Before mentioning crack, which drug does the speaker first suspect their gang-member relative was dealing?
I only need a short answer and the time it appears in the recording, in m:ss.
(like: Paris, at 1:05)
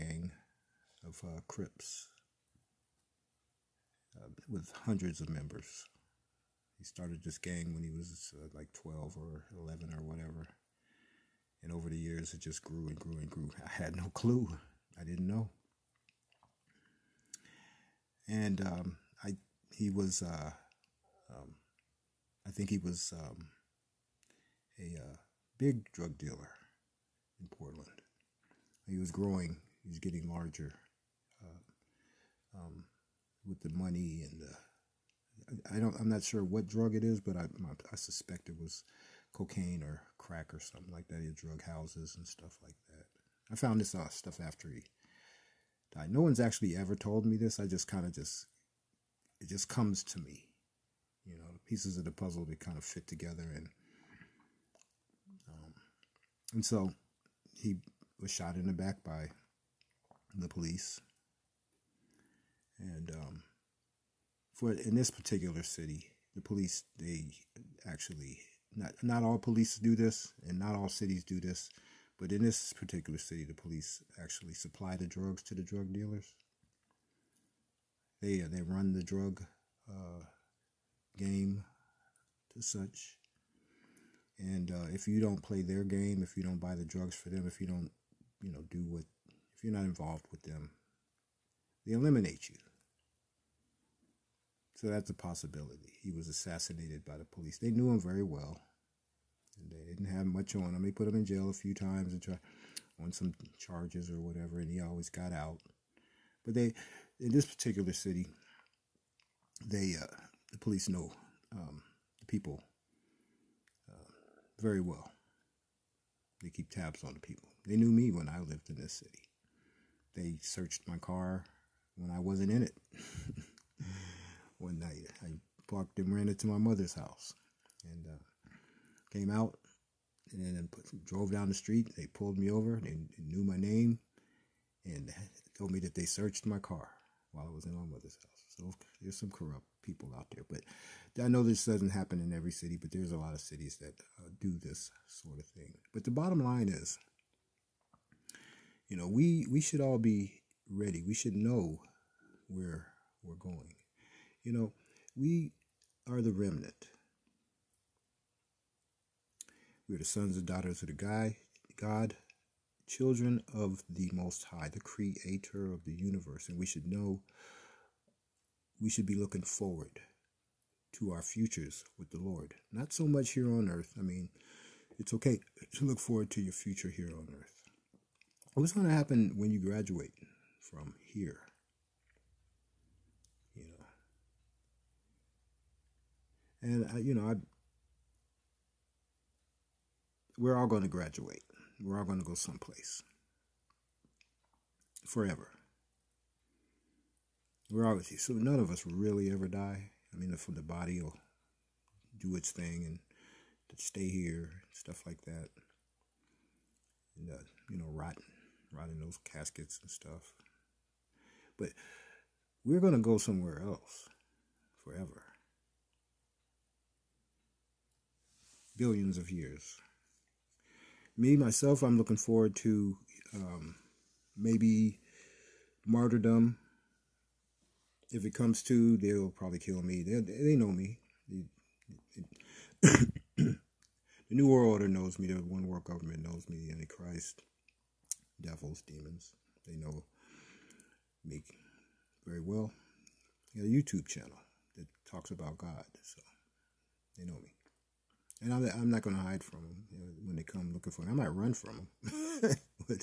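cocaine, at 0:39.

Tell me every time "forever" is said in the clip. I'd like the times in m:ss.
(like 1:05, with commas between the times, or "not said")
3:15, 3:34.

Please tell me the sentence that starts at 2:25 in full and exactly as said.
But the bottom line is, you know, we we should all be ready.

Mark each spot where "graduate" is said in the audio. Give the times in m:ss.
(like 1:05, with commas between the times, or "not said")
2:59, 3:10.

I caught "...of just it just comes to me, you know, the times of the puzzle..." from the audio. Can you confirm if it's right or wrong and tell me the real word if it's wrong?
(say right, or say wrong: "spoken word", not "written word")
wrong: "pieces", not "times".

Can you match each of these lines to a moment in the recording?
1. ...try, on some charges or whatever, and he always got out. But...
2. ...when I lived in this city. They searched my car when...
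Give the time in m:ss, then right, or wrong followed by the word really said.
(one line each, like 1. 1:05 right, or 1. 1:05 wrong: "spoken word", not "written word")
1. 1:42 right
2. 1:58 right.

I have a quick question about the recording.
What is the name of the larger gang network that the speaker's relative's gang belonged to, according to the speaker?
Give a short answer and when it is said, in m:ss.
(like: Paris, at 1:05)
Crips, at 0:01.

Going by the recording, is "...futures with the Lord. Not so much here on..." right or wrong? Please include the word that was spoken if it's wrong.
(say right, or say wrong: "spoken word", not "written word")
right.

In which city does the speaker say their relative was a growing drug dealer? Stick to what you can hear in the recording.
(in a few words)
Portland.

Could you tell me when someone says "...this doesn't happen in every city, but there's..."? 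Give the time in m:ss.
2:21.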